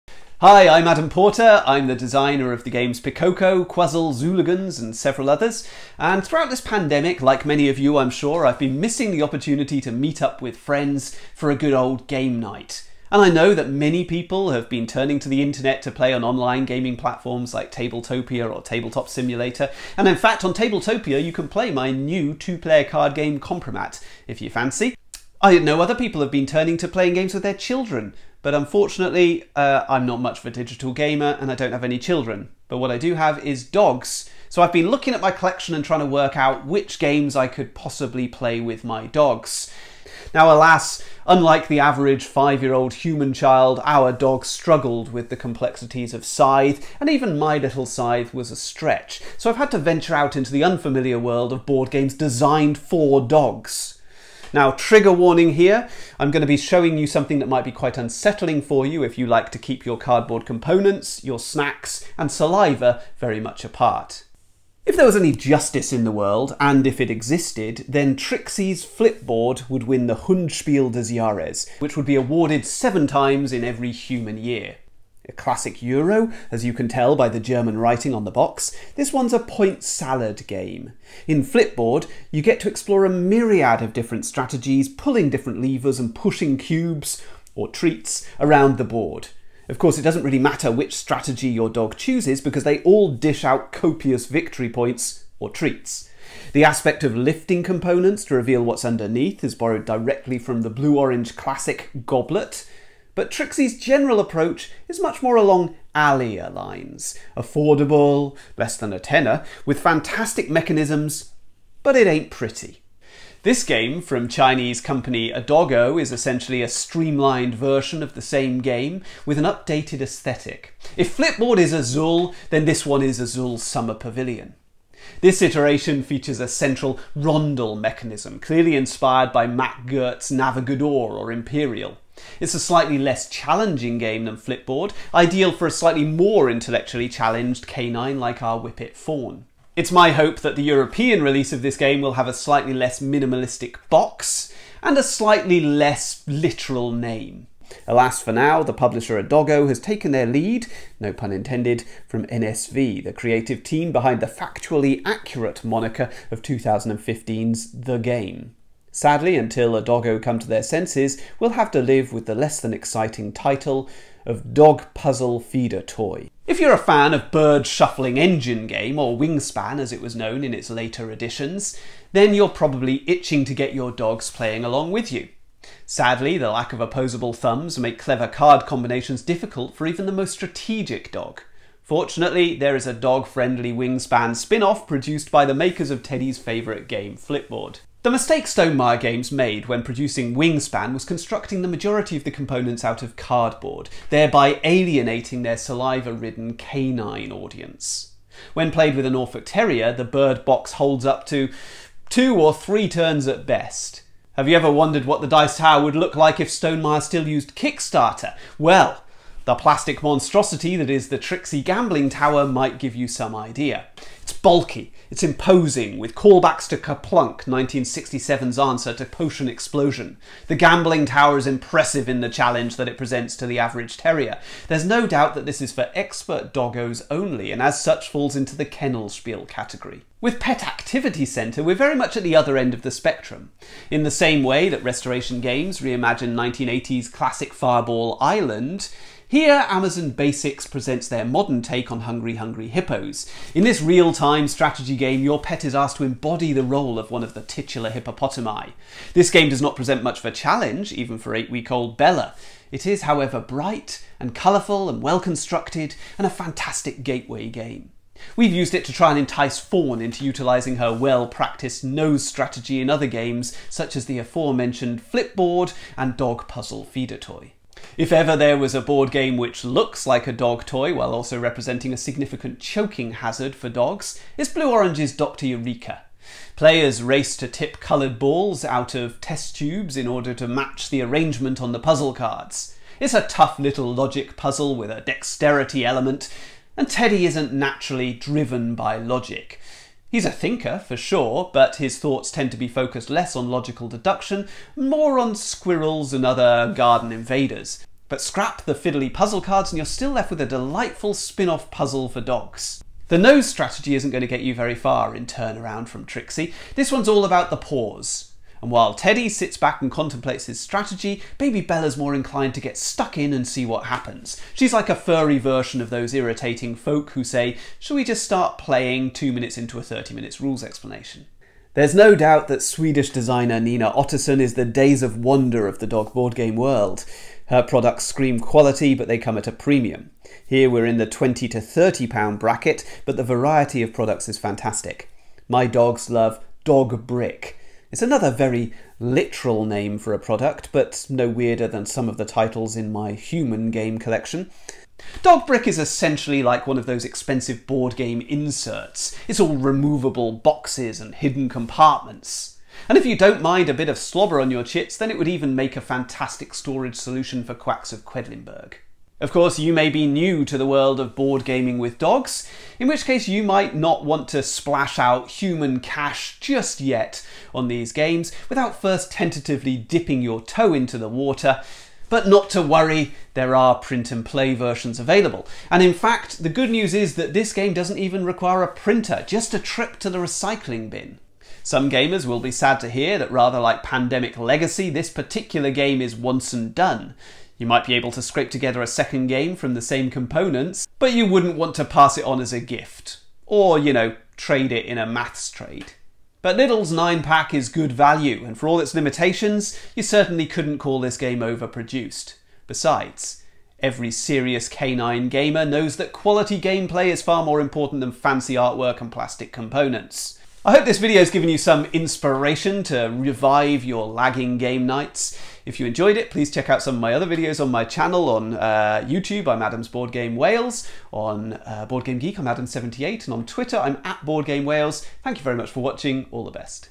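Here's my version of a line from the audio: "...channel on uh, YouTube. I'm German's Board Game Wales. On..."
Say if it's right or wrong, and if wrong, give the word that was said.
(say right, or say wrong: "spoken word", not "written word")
wrong: "Adam", not "German".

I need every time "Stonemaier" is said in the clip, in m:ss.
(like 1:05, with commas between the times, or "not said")
3:08, 3:26.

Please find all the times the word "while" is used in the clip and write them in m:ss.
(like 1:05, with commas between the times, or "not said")
4:30, 5:08.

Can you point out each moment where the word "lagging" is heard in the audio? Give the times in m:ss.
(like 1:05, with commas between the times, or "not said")
6:54.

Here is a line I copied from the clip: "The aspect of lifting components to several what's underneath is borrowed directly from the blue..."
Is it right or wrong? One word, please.
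wrong.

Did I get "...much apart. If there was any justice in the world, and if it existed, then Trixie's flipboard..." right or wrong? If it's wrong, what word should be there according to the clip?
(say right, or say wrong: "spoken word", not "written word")
right.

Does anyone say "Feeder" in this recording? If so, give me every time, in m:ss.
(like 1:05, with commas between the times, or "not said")
2:45, 4:26.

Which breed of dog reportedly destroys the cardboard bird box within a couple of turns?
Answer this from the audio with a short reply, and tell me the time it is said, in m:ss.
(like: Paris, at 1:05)
Norfolk Terrier, at 3:19.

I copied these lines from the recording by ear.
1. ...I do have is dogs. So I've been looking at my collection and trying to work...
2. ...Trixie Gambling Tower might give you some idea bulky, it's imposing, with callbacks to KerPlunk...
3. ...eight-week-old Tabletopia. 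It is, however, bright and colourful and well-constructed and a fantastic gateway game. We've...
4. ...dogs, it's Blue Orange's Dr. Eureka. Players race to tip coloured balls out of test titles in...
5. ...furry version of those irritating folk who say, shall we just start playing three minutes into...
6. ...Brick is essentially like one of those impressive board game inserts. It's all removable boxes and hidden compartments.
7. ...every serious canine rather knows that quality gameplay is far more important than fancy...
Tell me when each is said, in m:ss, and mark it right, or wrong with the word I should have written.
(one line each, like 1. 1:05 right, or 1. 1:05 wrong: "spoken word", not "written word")
1. 0:32 right
2. 3:31 right
3. 4:11 wrong: "Bella", not "Tabletopia"
4. 4:33 wrong: "tubes", not "titles"
5. 5:14 wrong: "two", not "three"
6. 5:45 wrong: "expensive", not "impressive"
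7. 6:43 wrong: "gamer", not "rather".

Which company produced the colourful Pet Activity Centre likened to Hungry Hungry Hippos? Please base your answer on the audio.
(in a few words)
Amazon Basics.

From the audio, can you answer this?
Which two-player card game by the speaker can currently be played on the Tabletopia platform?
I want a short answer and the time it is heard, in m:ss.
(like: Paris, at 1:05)
Compromat, at 0:23.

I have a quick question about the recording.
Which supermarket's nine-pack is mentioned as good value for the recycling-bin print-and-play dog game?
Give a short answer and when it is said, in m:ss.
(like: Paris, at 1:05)
Lidl, at 6:36.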